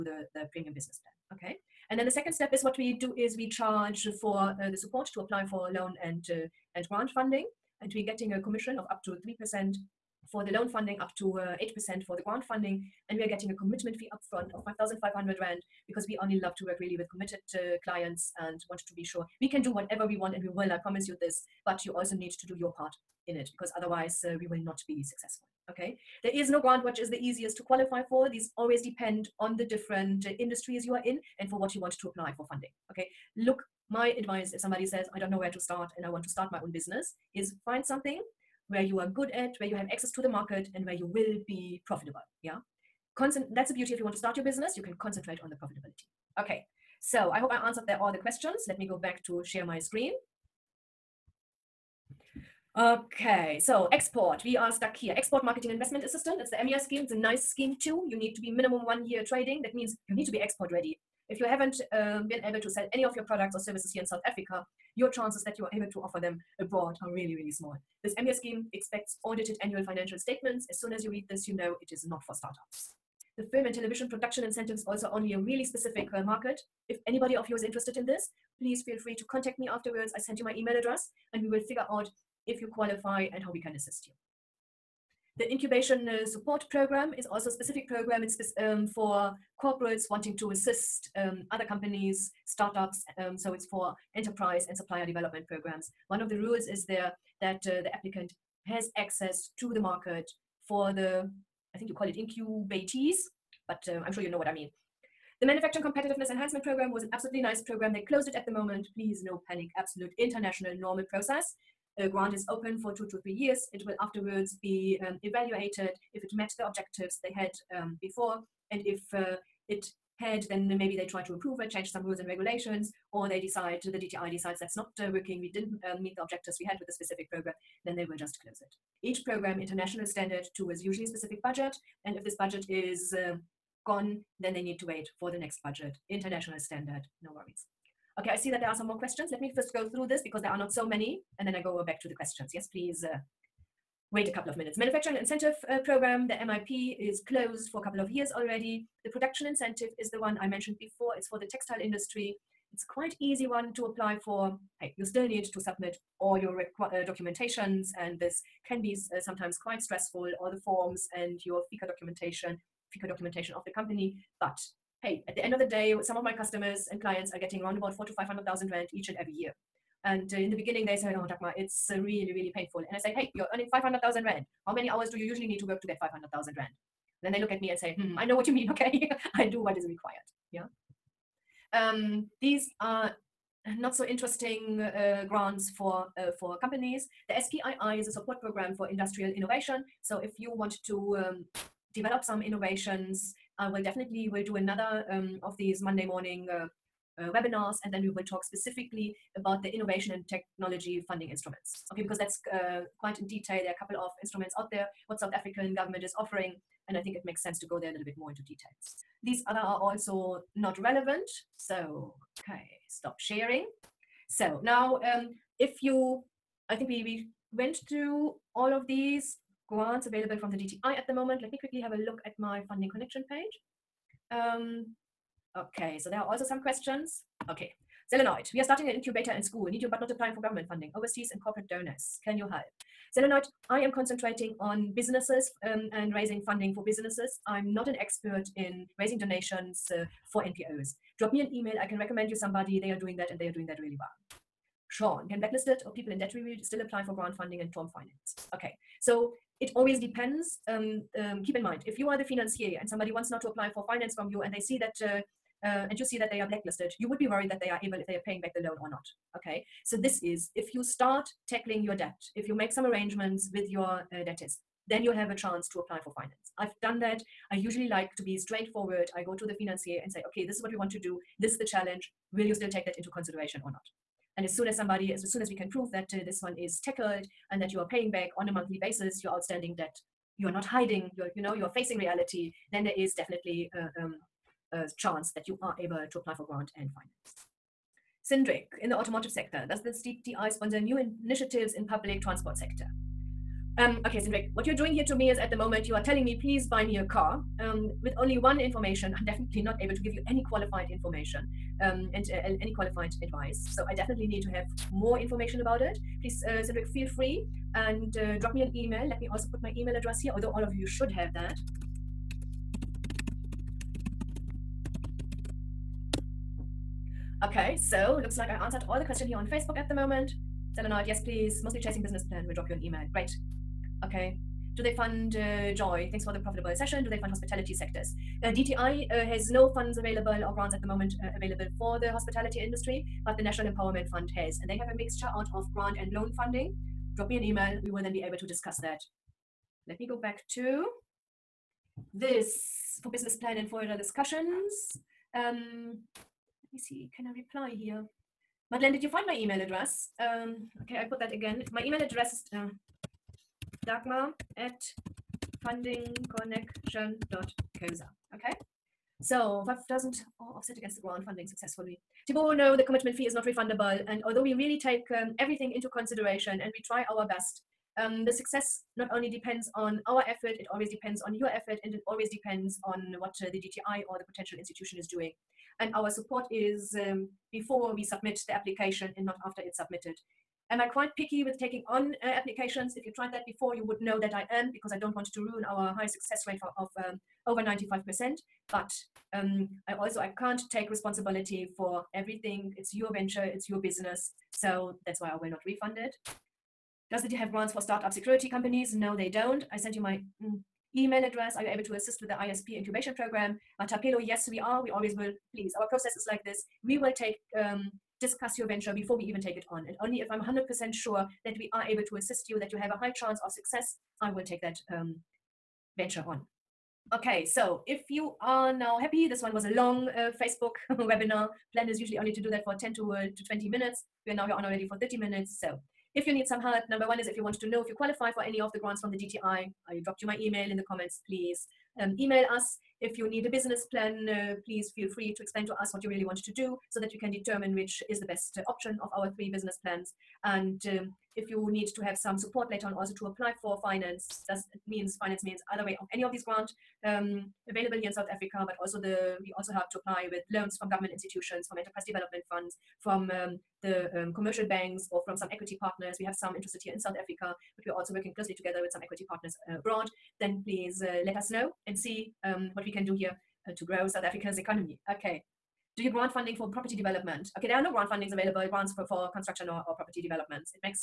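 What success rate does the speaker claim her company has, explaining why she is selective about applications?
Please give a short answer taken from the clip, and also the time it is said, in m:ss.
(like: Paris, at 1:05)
over 95%, at 6:27.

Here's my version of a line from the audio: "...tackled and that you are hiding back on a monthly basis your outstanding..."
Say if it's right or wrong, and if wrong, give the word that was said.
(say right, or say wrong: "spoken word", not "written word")
wrong: "paying", not "hiding".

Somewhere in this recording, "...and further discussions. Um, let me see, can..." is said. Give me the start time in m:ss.
5:43.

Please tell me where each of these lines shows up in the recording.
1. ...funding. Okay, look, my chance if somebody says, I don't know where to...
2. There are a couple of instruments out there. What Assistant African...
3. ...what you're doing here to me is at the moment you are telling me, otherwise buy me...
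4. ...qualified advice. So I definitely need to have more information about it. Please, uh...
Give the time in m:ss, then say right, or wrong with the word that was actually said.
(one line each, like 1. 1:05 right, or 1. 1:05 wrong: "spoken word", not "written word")
1. 0:32 wrong: "advice", not "chance"
2. 3:23 wrong: "South", not "Assistant"
3. 4:54 wrong: "please", not "otherwise"
4. 5:02 right.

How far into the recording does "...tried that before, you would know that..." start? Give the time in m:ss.
6:23.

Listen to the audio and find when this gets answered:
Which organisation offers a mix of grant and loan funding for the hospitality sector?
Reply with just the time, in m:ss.
5:33.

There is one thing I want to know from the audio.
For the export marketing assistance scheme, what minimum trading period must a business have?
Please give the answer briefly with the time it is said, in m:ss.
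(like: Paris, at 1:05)
1 year, at 0:58.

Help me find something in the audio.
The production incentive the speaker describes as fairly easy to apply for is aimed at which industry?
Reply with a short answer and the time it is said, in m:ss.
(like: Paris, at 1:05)
textile industry, at 2:31.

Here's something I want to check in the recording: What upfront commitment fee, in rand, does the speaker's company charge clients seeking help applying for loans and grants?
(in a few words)
5,500 Rand.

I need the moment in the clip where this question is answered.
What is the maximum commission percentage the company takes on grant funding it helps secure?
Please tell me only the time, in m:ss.
0:11.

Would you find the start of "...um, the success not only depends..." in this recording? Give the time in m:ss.
6:07.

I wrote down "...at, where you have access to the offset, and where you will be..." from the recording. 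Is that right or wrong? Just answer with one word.
wrong.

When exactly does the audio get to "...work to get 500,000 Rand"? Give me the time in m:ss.
2:55.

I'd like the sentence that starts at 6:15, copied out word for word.
And our support is um, before we submit the application and not after it's submitted.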